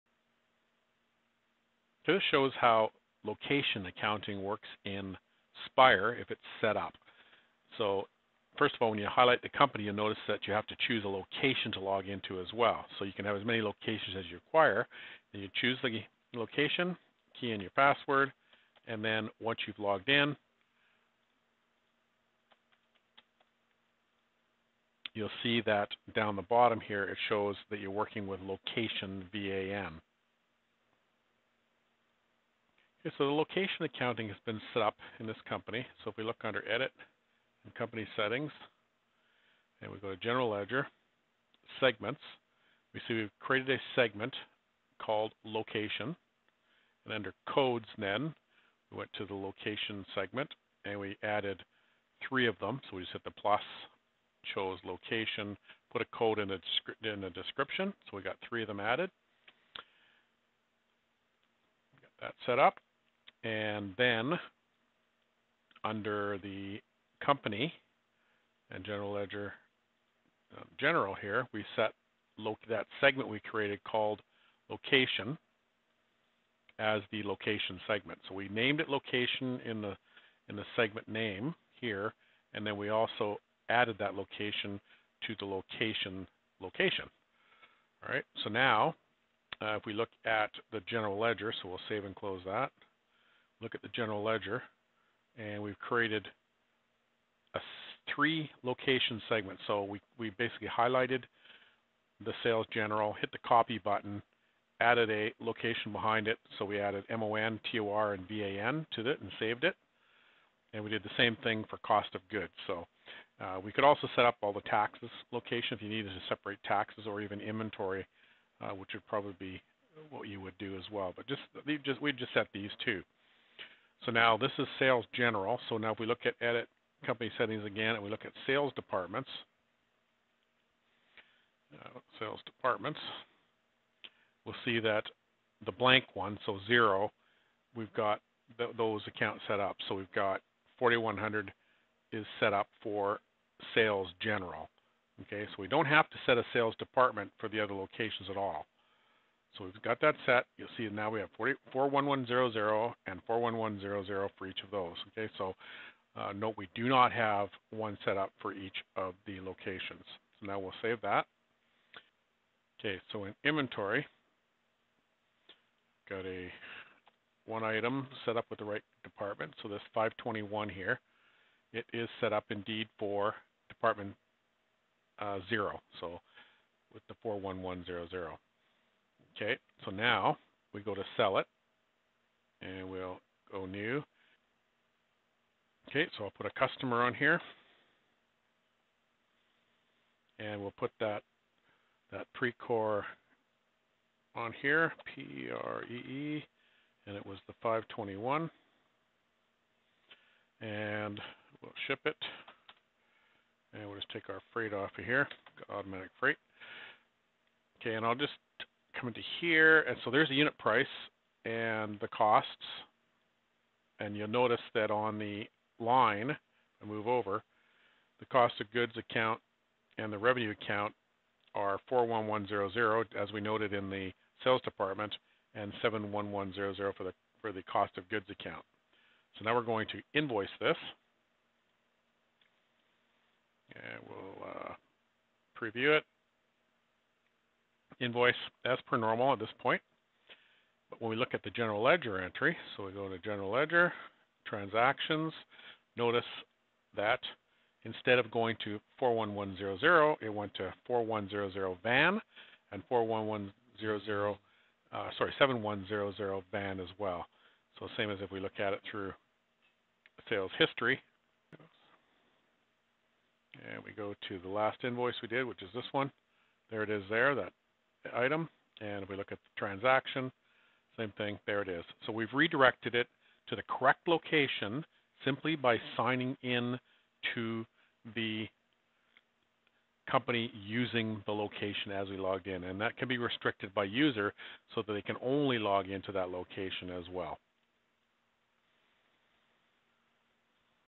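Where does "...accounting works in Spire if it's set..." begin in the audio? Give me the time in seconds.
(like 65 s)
3 s.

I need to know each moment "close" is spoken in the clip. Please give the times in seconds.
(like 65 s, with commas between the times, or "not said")
92 s.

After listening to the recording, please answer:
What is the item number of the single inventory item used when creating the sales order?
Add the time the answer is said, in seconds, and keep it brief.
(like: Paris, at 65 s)
521, at 169 s.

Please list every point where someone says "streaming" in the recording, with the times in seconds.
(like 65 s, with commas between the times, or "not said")
not said.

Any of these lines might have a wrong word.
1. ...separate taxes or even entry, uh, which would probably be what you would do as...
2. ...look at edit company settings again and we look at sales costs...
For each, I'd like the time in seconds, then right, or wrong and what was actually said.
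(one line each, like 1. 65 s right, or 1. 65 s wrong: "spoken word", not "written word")
1. 116 s wrong: "inventory", not "entry"
2. 126 s wrong: "departments", not "costs".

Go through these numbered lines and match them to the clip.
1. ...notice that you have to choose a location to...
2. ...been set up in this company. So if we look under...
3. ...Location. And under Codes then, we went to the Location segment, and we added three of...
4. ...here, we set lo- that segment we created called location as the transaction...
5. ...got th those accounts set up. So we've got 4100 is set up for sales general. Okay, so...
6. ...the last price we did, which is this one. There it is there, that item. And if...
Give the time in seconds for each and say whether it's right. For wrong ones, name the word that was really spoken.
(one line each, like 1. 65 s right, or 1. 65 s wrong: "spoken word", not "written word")
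1. 9 s right
2. 34 s right
3. 45 s right
4. 71 s wrong: "location", not "transaction"
5. 137 s right
6. 264 s wrong: "invoice", not "price".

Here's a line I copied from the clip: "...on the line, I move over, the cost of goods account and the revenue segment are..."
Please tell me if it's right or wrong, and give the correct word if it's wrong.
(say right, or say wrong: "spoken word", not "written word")
wrong: "account", not "segment".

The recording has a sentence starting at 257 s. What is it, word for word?
So same as if we look at it through sales history.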